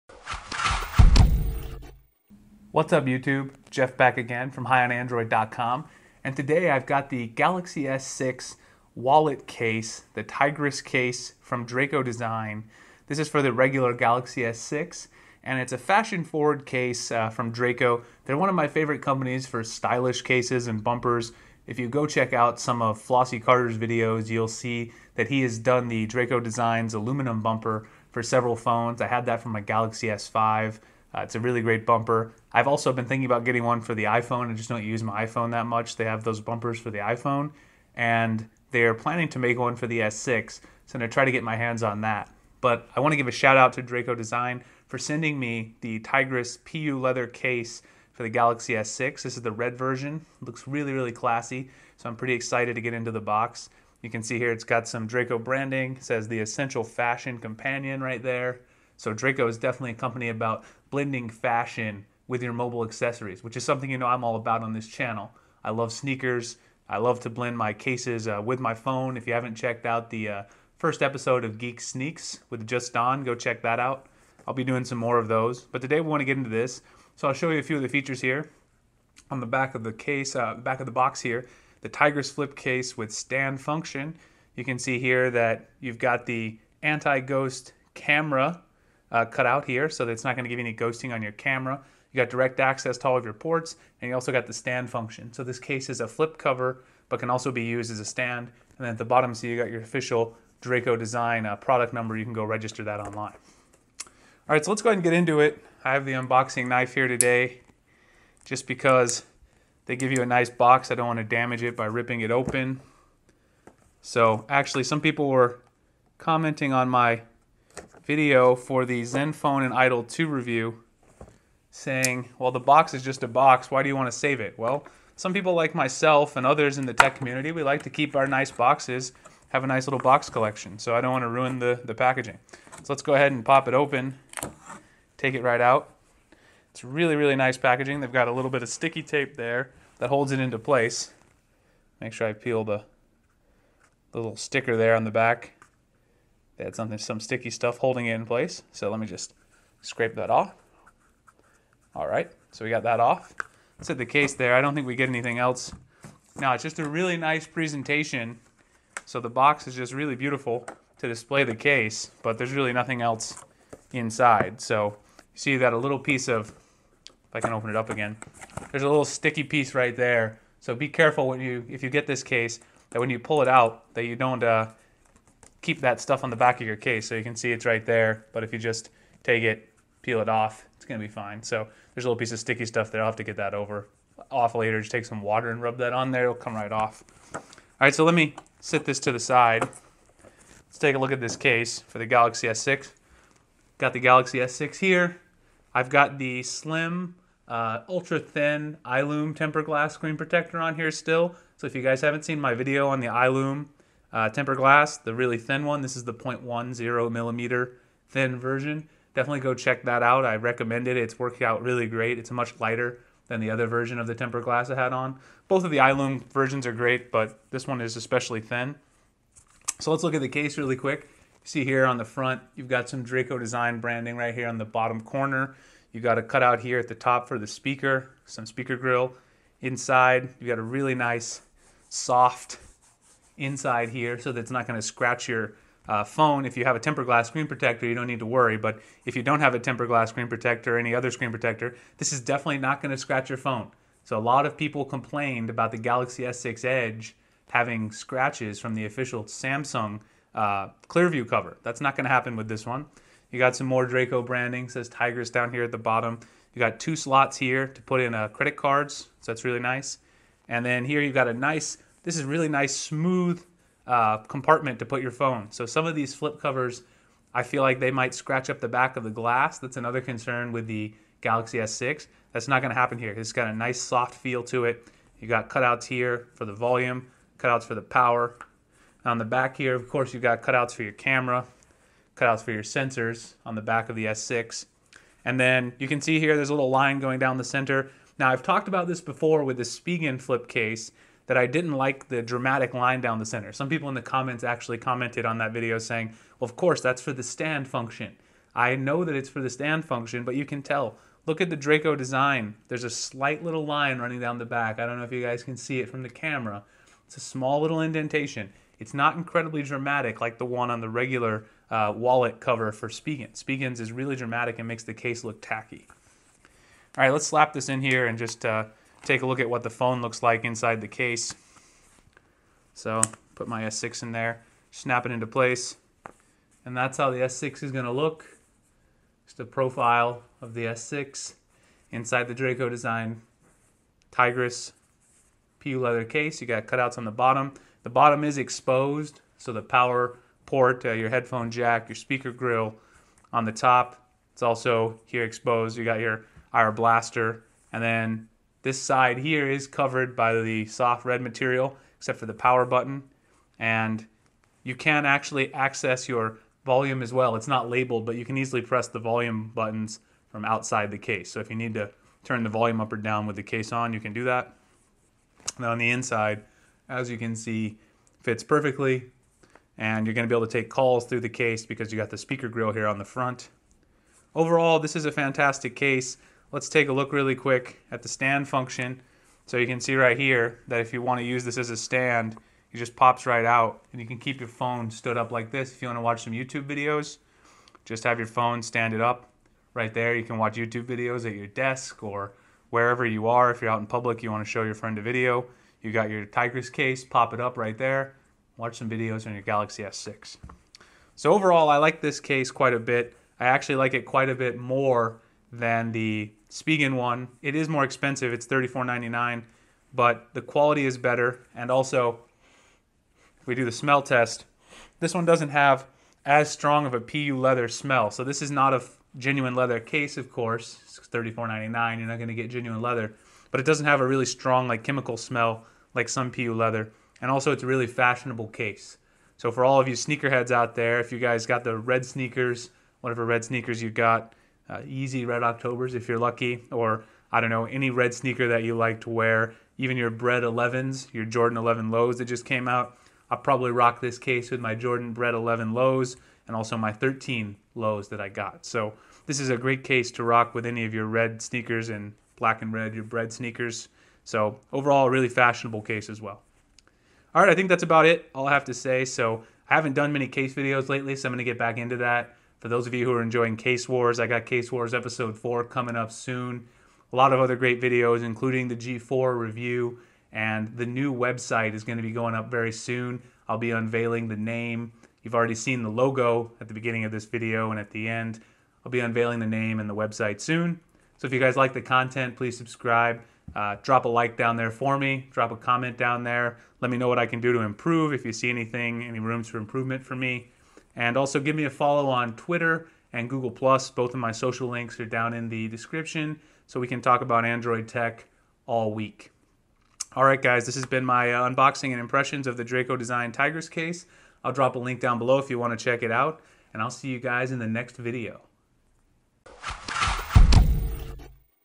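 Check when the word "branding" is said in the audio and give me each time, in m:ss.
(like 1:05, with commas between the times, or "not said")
0:55, 3:43, 4:14.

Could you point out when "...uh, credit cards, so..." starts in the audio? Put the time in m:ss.
4:18.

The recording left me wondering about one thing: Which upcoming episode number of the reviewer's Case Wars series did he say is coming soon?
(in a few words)
4.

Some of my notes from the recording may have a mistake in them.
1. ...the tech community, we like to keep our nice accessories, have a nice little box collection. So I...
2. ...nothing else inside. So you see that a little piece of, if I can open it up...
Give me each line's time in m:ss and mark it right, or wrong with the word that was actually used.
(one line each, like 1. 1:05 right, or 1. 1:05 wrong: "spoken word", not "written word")
1. 2:06 wrong: "boxes", not "accessories"
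2. 2:42 right.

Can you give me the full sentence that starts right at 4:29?
That's another concern with the Galaxy S6.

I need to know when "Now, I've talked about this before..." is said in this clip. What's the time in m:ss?
4:48.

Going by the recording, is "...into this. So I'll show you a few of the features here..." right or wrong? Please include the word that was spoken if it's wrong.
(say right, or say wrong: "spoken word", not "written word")
right.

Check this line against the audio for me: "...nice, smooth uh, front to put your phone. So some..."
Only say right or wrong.
wrong.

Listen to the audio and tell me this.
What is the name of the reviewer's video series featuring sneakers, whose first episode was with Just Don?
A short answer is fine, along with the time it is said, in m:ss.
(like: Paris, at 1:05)
Geek Sneaks, at 1:11.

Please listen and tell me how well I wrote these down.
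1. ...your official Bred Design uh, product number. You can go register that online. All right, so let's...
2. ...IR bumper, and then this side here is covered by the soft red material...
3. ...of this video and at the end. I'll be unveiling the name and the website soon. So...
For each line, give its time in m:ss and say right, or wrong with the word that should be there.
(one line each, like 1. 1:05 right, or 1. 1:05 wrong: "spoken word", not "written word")
1. 1:39 wrong: "Draco", not "Bred"
2. 5:46 wrong: "blaster", not "bumper"
3. 7:57 right.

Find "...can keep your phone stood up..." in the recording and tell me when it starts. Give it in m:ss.
6:24.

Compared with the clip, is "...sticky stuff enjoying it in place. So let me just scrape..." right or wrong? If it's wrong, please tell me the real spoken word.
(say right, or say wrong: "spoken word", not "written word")
wrong: "holding", not "enjoying".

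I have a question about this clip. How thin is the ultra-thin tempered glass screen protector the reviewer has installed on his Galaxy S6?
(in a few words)
0.10 millimeter.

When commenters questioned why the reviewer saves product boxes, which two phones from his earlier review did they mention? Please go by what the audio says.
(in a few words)
Zenfone and Idol 2.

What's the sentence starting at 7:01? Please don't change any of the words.
You're not going to get genuine leather, but it doesn't have a really strong like chemical smell like some PU leather.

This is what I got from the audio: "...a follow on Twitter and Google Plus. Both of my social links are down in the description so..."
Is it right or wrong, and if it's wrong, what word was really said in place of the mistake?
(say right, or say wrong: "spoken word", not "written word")
right.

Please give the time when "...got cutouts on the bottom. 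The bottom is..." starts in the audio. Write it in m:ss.
5:36.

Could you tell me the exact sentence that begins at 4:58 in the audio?
I know that it's for the stand function, but you can tell.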